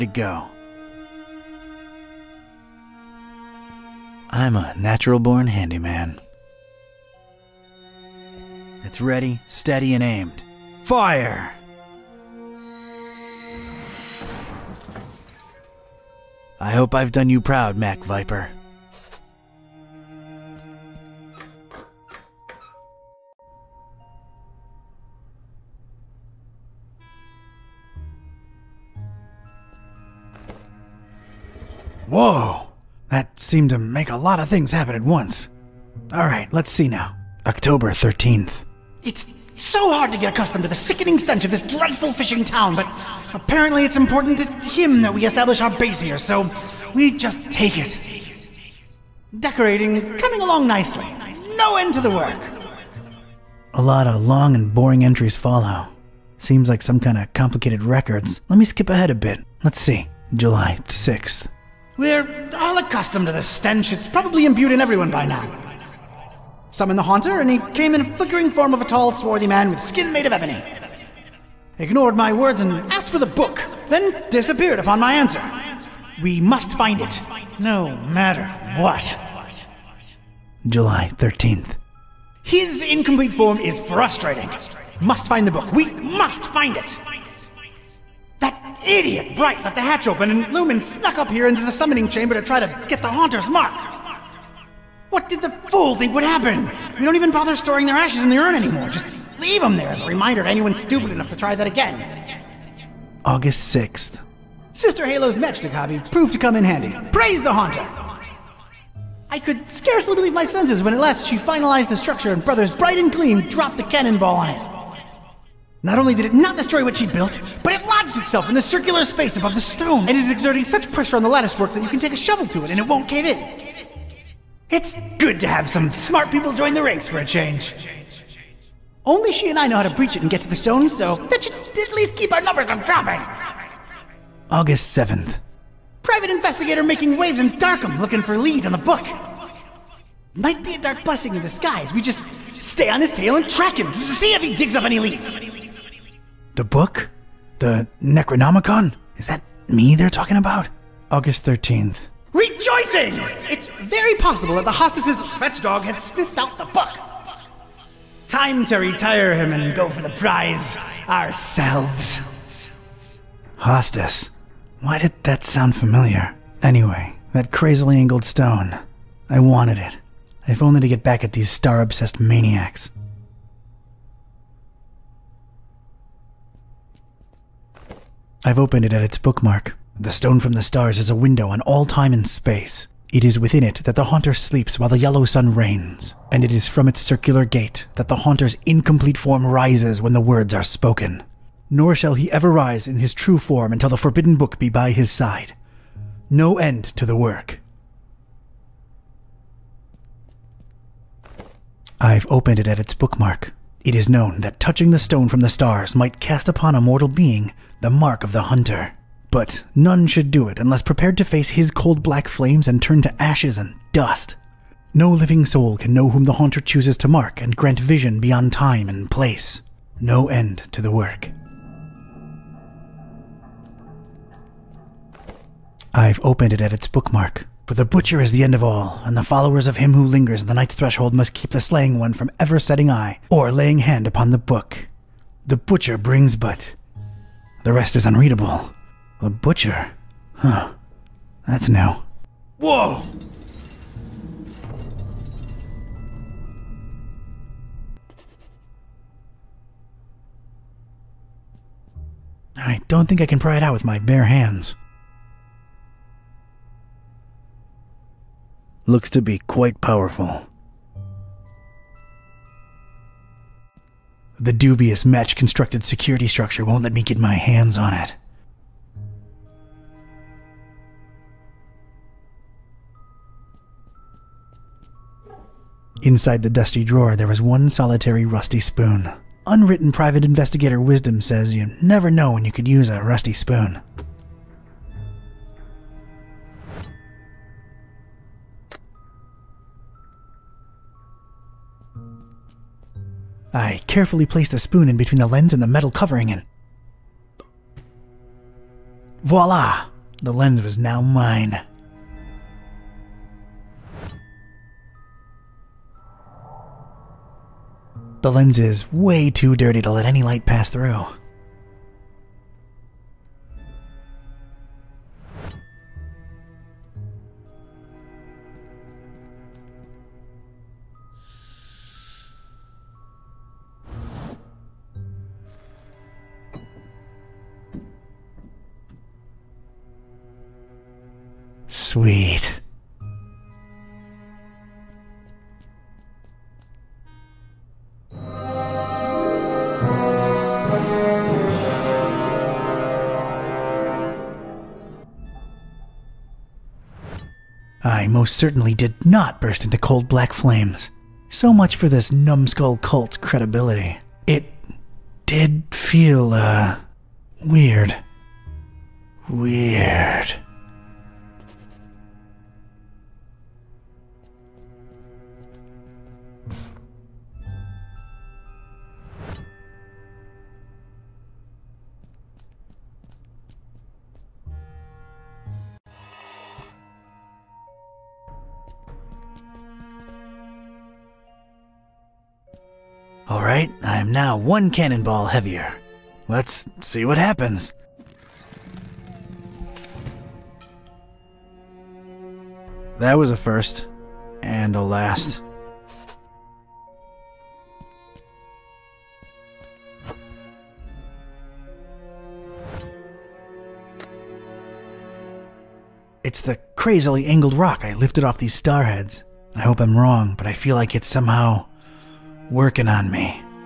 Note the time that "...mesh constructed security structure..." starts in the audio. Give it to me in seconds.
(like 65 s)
265 s.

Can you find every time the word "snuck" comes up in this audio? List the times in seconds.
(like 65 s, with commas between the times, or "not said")
90 s.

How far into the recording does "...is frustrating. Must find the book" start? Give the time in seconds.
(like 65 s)
83 s.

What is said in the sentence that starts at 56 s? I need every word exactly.
Seems like some kind of complicated records.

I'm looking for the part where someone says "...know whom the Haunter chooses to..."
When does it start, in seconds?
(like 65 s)
215 s.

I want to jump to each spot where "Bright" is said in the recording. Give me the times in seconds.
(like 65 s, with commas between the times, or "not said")
89 s, 112 s.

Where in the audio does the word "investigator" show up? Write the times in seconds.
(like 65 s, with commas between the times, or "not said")
136 s, 280 s.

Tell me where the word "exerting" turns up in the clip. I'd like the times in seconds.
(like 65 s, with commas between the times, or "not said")
120 s.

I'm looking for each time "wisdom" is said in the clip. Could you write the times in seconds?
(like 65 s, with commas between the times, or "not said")
280 s.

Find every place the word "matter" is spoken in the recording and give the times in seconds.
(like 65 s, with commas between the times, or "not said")
77 s.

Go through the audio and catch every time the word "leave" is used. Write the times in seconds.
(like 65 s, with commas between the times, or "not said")
99 s.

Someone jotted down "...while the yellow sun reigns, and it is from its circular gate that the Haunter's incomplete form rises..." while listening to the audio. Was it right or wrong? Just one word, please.
right.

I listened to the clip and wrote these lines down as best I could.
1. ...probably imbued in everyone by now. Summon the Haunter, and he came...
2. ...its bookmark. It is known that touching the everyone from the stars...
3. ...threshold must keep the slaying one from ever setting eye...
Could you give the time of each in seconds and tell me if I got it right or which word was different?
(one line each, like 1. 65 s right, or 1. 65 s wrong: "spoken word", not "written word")
1. 64 s right
2. 202 s wrong: "stone", not "everyone"
3. 230 s right.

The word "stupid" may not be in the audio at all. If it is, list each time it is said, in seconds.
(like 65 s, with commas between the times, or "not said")
100 s.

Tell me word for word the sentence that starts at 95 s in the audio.
What did the fool think would happen?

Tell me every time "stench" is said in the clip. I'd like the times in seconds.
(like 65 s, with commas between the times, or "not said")
41 s, 63 s.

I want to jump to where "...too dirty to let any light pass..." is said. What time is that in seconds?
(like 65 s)
309 s.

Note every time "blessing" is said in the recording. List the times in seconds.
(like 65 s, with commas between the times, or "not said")
141 s.